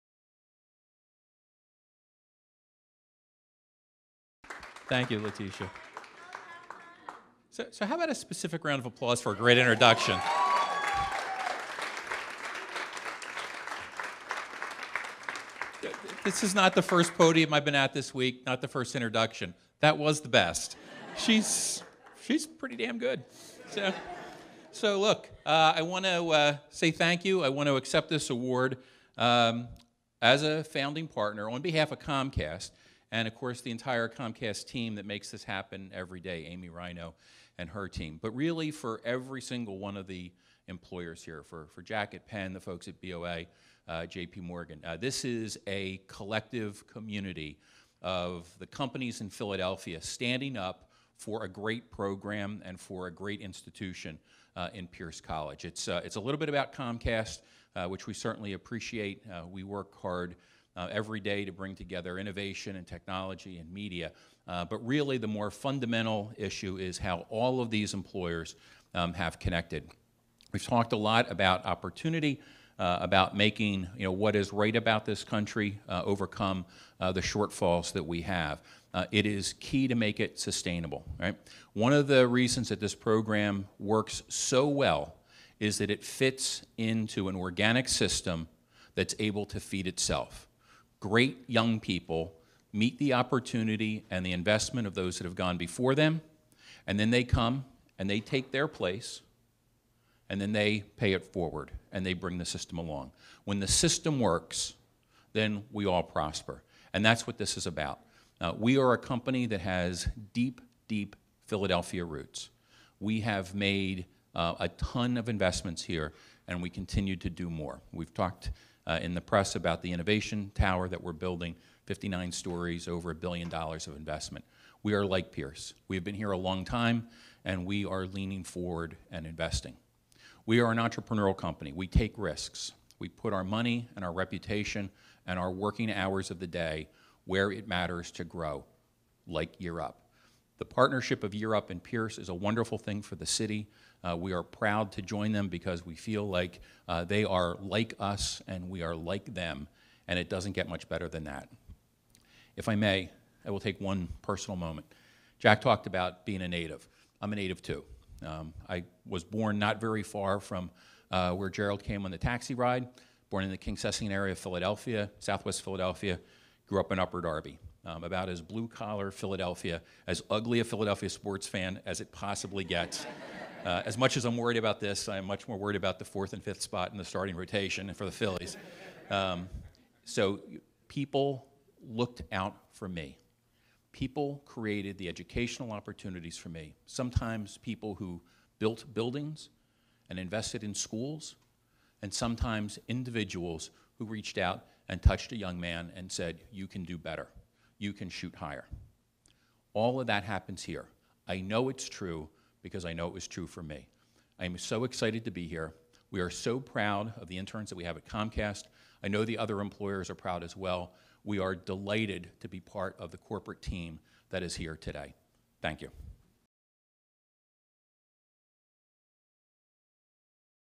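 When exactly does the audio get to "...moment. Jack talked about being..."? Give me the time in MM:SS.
02:34.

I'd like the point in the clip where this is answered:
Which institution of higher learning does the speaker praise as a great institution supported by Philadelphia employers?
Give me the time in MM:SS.
00:54.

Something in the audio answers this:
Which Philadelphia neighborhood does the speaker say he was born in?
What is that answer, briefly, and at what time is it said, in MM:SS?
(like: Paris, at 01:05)
Kingsessing, at 02:43.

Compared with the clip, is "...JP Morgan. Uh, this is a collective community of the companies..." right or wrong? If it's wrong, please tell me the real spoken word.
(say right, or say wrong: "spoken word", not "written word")
right.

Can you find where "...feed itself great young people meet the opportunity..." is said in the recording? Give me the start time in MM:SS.
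01:29.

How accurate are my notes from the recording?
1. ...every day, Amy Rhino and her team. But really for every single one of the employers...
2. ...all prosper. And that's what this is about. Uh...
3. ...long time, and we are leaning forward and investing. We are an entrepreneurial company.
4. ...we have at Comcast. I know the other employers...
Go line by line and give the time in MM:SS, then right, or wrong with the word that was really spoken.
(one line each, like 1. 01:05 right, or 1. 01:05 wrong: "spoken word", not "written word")
1. 00:35 right
2. 01:45 right
3. 02:06 right
4. 03:27 right.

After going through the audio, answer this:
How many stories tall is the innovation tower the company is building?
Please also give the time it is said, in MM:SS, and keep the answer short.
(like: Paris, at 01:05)
59, at 02:01.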